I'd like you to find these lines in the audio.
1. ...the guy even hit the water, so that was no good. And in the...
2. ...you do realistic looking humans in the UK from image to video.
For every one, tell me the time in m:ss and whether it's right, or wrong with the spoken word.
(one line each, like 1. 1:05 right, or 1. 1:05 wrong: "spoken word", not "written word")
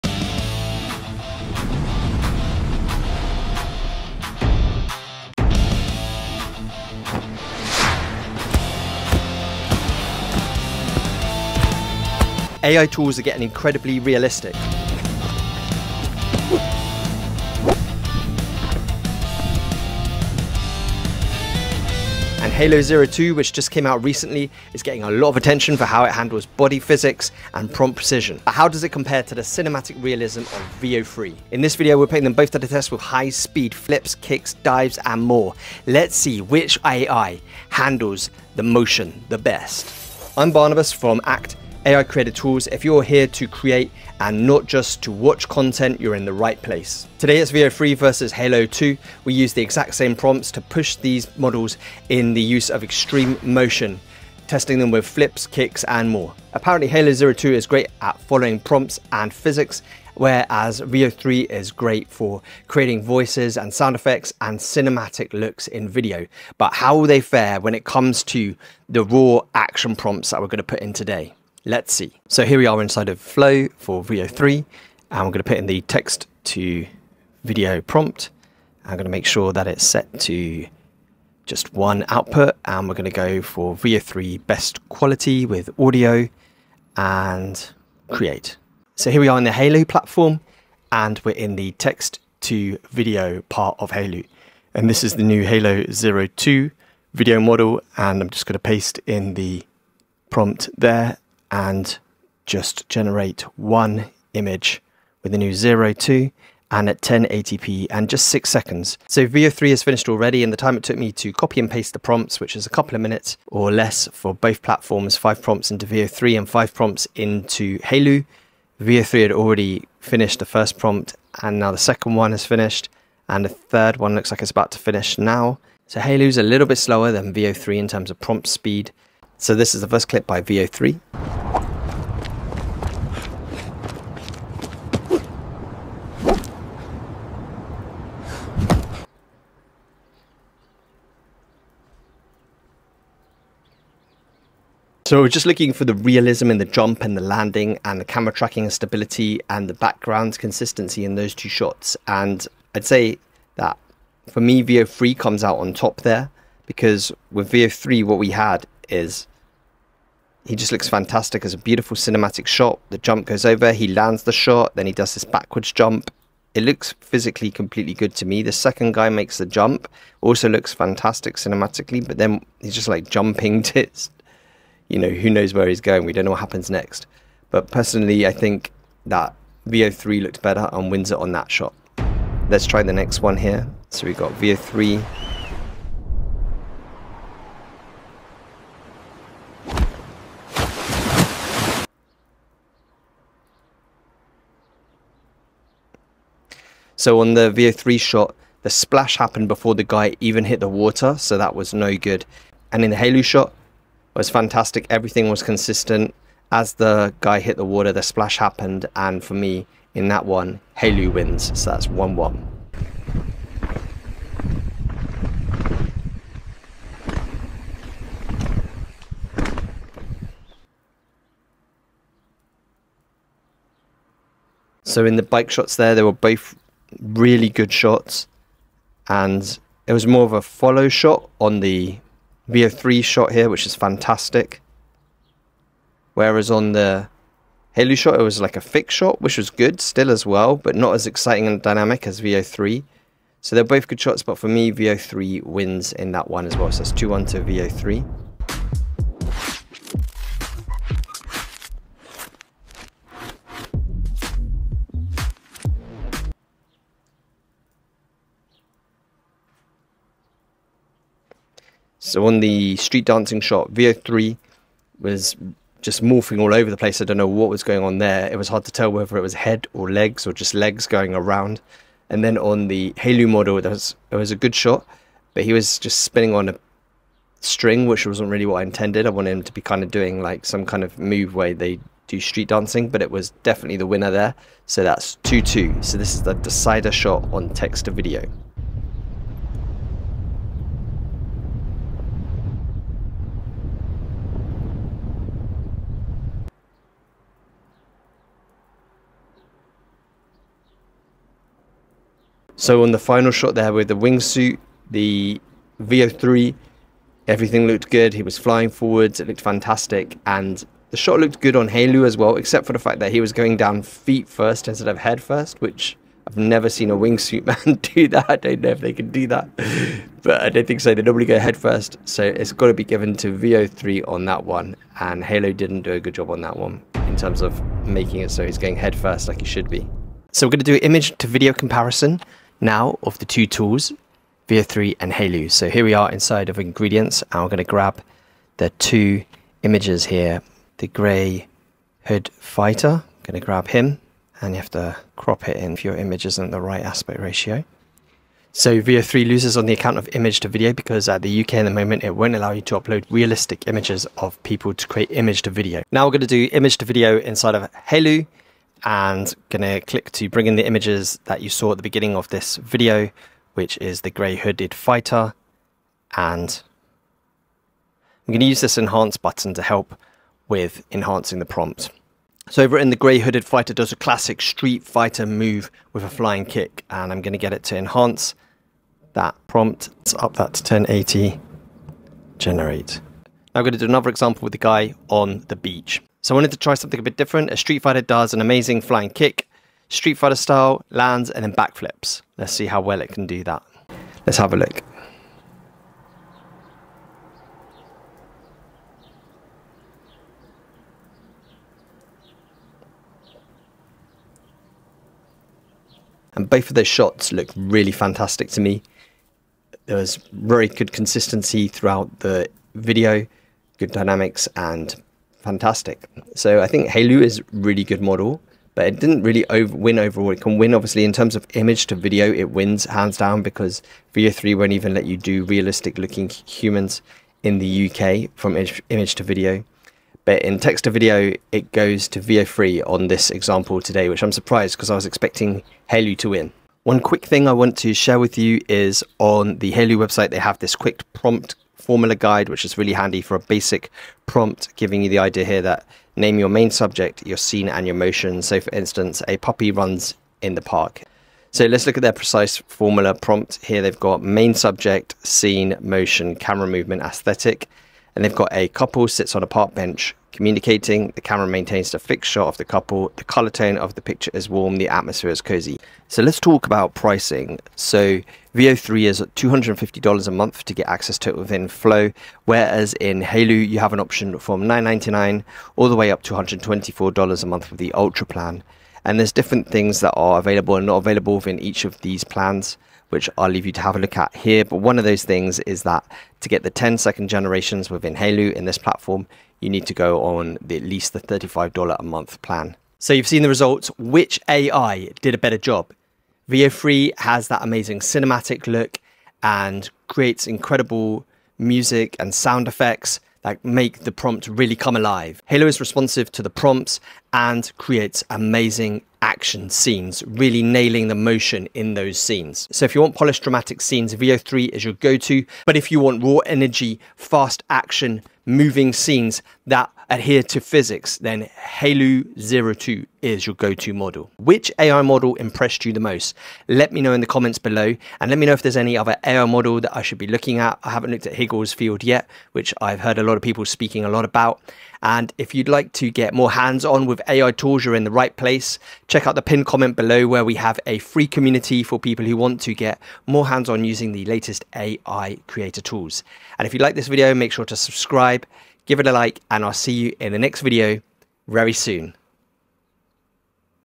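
1. 3:19 right
2. 7:05 right.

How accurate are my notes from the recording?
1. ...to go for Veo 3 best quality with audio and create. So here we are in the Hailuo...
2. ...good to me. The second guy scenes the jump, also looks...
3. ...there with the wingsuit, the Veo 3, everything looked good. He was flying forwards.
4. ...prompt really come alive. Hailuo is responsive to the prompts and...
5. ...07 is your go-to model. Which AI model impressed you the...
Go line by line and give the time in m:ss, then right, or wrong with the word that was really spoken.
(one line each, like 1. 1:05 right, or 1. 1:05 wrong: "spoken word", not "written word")
1. 1:23 right
2. 2:47 wrong: "makes", not "scenes"
3. 5:03 right
4. 8:24 right
5. 8:42 wrong: "02", not "07".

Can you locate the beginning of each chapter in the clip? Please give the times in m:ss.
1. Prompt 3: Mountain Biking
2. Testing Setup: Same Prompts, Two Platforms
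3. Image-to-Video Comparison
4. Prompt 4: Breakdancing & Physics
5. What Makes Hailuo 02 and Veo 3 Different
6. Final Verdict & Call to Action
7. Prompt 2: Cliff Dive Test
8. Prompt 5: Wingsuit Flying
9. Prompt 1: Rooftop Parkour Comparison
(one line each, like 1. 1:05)
1. 3:44
2. 1:12
3. 5:30
4. 4:22
5. 0:31
6. 8:13
7. 3:02
8. 5:02
9. 2:09.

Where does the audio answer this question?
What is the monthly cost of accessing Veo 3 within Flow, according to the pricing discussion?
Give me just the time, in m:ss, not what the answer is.
7:49.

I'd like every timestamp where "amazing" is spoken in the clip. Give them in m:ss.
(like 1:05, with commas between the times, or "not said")
6:28, 8:17, 8:28.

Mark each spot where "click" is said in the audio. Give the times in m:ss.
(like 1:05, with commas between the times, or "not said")
5:59.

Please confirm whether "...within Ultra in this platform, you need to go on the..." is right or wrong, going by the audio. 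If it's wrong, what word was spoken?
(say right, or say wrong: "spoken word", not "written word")
wrong: "Hailuo", not "Ultra".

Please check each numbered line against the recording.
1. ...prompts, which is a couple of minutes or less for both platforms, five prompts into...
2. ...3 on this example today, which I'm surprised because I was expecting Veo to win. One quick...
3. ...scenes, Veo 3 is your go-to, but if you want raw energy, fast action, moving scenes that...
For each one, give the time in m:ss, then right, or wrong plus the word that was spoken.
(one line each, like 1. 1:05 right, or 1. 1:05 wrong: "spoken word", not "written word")
1. 1:51 right
2. 7:12 wrong: "Hailuo", not "Veo"
3. 8:33 right.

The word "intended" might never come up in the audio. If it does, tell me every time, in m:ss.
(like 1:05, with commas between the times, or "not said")
4:38.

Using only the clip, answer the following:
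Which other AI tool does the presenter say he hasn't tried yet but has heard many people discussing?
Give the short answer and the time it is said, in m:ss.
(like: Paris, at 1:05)
Higgsfield, at 8:51.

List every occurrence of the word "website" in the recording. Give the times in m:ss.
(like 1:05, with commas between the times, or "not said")
7:19.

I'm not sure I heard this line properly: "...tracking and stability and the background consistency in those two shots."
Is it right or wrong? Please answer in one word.
right.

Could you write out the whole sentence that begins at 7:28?
So, for instance, a puppy runs in the park.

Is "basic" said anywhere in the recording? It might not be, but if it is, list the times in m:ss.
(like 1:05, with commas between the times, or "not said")
7:23.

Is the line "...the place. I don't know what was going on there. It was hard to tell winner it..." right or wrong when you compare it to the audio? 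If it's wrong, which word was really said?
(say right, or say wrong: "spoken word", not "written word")
wrong: "whether", not "winner".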